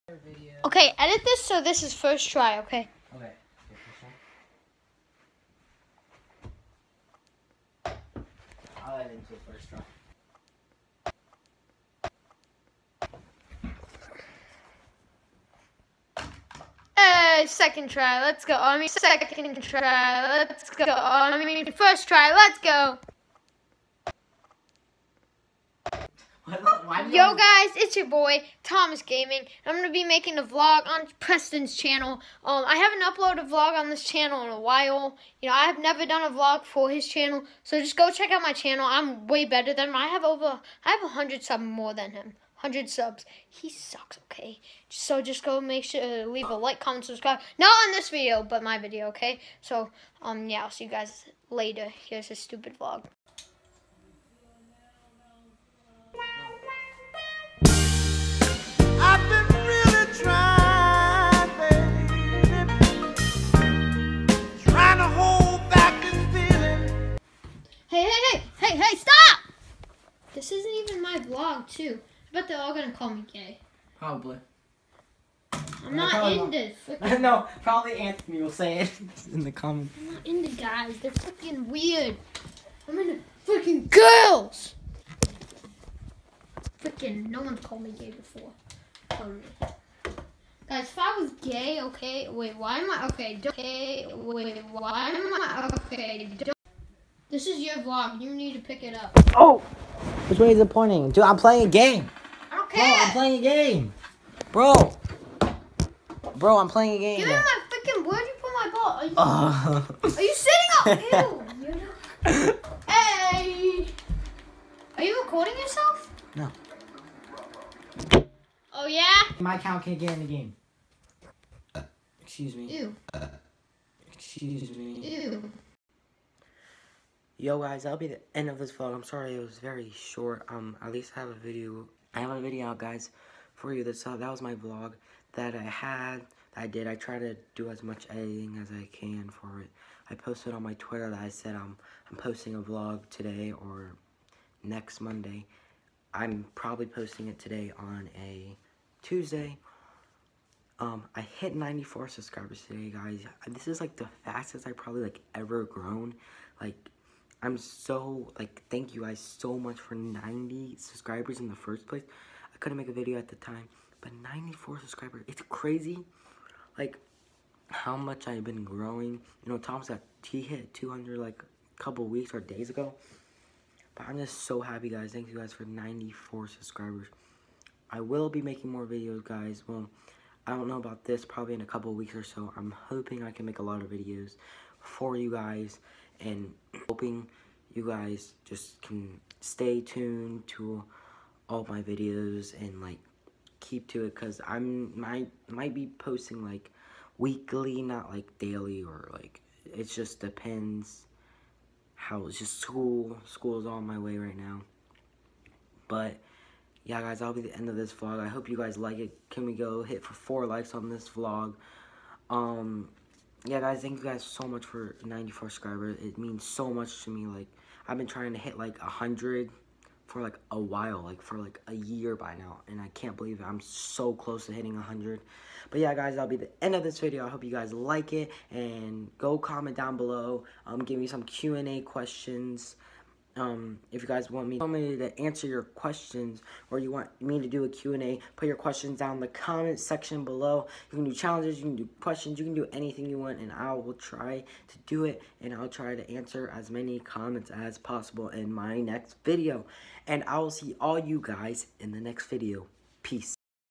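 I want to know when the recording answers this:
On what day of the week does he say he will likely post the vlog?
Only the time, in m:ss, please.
2:29.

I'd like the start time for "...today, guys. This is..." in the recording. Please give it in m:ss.
2:32.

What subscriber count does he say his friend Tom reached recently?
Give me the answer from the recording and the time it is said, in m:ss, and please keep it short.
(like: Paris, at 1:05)
200, at 2:50.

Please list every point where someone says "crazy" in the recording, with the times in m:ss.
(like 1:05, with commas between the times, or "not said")
2:45.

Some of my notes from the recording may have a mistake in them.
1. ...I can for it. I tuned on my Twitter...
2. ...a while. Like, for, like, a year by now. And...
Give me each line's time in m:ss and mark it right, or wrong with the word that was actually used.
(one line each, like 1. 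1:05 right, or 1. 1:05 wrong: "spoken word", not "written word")
1. 2:18 wrong: "posted", not "tuned"
2. 3:40 right.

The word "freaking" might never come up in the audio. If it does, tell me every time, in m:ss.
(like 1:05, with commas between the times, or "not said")
1:26, 1:47.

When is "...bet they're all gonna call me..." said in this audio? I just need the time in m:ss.
1:12.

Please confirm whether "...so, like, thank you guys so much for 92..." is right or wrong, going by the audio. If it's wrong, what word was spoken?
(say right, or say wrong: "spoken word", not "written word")
wrong: "90", not "92".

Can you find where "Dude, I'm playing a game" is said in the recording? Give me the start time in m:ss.
1:41.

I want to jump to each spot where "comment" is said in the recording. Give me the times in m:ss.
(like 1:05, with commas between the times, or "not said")
0:46, 1:19, 3:49, 3:59, 4:06.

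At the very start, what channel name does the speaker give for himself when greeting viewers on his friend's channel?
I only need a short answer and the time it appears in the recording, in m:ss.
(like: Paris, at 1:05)
Thomas Gaming, at 0:28.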